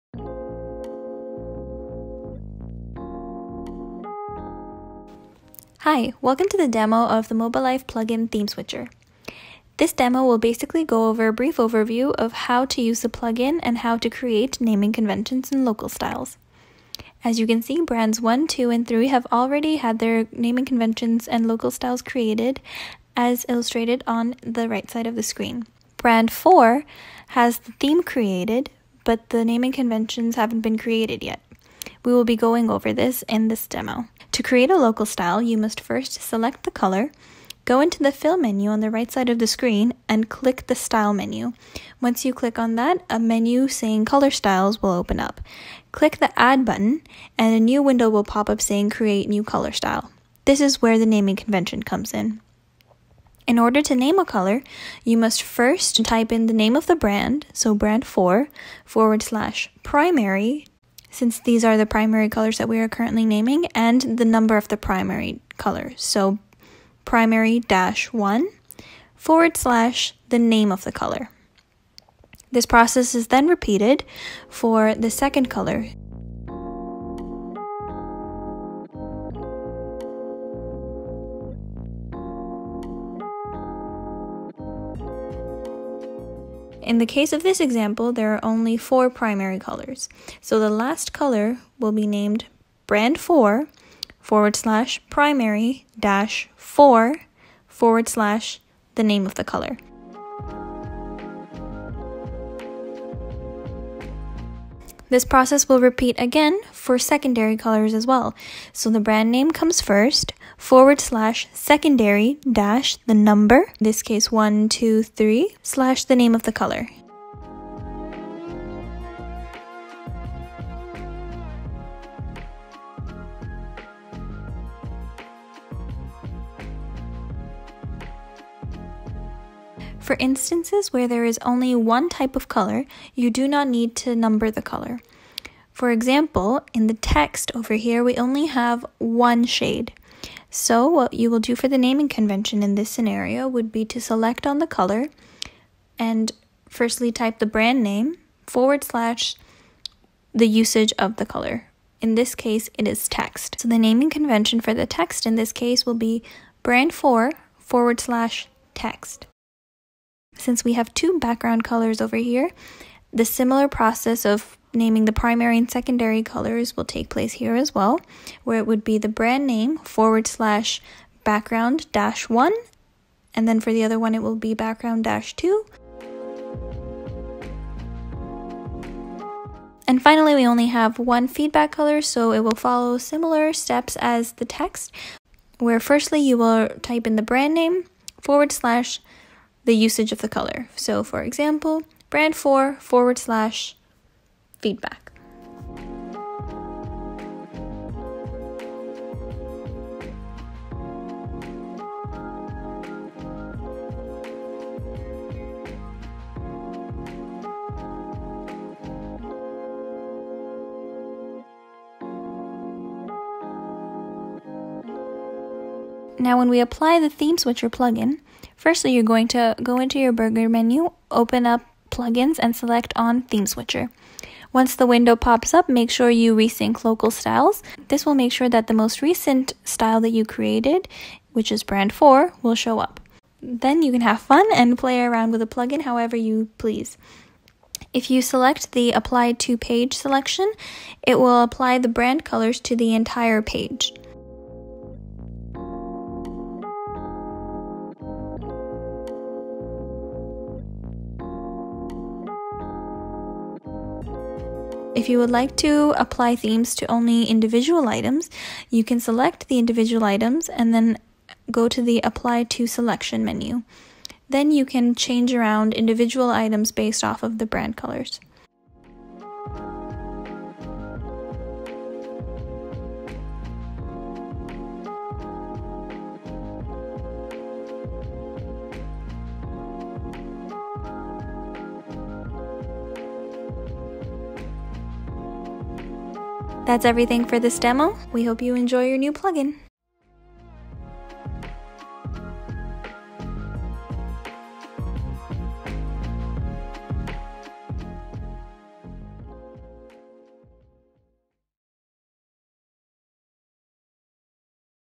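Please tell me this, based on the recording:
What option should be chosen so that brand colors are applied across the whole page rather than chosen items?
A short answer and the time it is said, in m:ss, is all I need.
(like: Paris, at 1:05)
apply to page, at 3:58.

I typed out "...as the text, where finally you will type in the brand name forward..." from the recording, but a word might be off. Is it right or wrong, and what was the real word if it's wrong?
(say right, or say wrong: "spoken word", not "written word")
wrong: "firstly", not "finally".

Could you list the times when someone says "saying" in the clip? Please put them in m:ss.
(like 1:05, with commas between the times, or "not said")
0:43, 0:48.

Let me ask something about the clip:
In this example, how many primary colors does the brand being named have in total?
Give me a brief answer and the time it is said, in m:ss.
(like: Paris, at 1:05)
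4, at 1:28.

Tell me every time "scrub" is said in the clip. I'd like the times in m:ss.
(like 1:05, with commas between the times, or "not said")
not said.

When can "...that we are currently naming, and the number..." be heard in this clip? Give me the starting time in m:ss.
1:02.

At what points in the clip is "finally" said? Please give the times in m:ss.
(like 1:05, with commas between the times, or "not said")
3:00.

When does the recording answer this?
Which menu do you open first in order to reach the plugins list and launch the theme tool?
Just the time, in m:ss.
3:40.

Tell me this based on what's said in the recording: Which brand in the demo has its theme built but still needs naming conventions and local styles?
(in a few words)
Brand 4.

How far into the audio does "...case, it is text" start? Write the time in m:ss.
2:32.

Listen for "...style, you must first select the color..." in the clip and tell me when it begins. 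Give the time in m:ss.
0:35.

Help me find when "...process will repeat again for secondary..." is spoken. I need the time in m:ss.
1:45.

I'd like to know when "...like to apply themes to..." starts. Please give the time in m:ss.
4:15.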